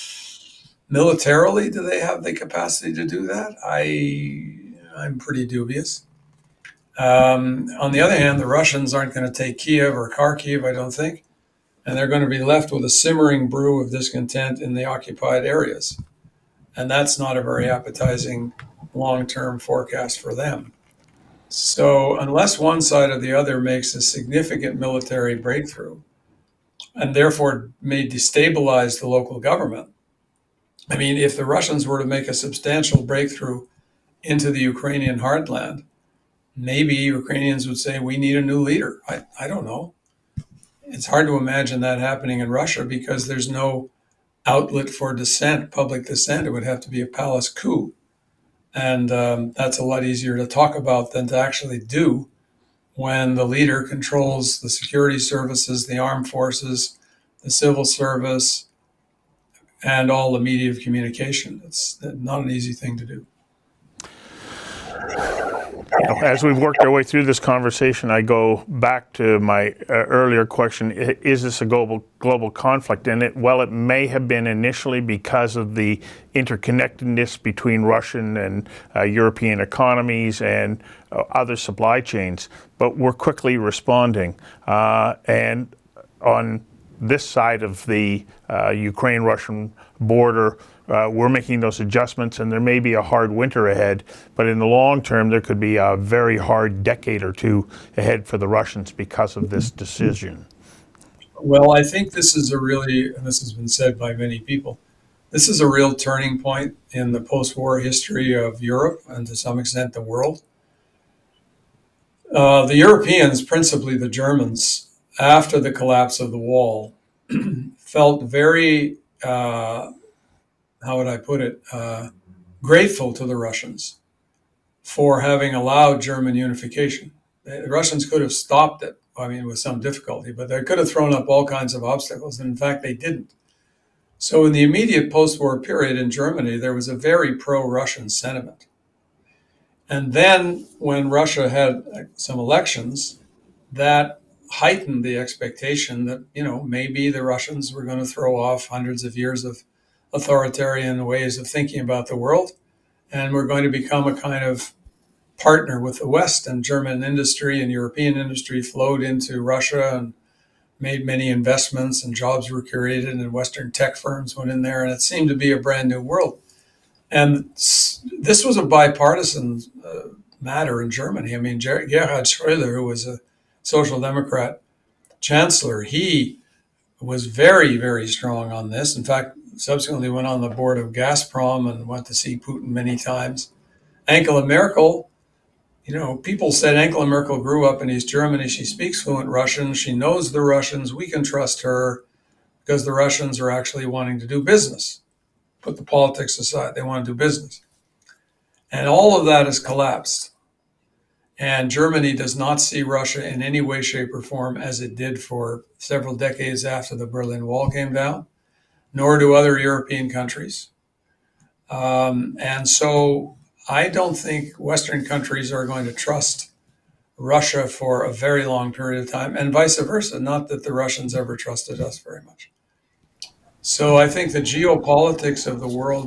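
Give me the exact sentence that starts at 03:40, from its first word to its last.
Not that the Russians ever trusted us very much.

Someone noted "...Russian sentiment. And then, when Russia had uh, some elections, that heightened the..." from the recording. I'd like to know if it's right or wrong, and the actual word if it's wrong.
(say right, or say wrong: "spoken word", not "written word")
right.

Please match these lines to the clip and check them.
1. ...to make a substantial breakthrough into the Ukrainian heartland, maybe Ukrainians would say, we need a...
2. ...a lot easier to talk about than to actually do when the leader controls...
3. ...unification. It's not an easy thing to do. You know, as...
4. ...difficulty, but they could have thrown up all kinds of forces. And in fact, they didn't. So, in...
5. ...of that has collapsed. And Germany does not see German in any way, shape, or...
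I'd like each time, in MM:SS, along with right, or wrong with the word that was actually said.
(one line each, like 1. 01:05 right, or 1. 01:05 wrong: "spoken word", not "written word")
1. 00:31 right
2. 00:49 right
3. 01:00 wrong: "communication", not "unification"
4. 02:09 wrong: "obstacles", not "forces"
5. 03:19 wrong: "Russia", not "German".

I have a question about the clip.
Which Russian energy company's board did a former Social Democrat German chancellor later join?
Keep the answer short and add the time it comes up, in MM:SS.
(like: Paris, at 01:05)
Gazprom, at 03:00.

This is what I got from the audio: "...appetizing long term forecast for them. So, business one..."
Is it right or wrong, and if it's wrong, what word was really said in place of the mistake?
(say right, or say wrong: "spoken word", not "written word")
wrong: "unless", not "business".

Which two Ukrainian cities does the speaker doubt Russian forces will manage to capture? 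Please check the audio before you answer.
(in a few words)
Kiev or Kharkiv.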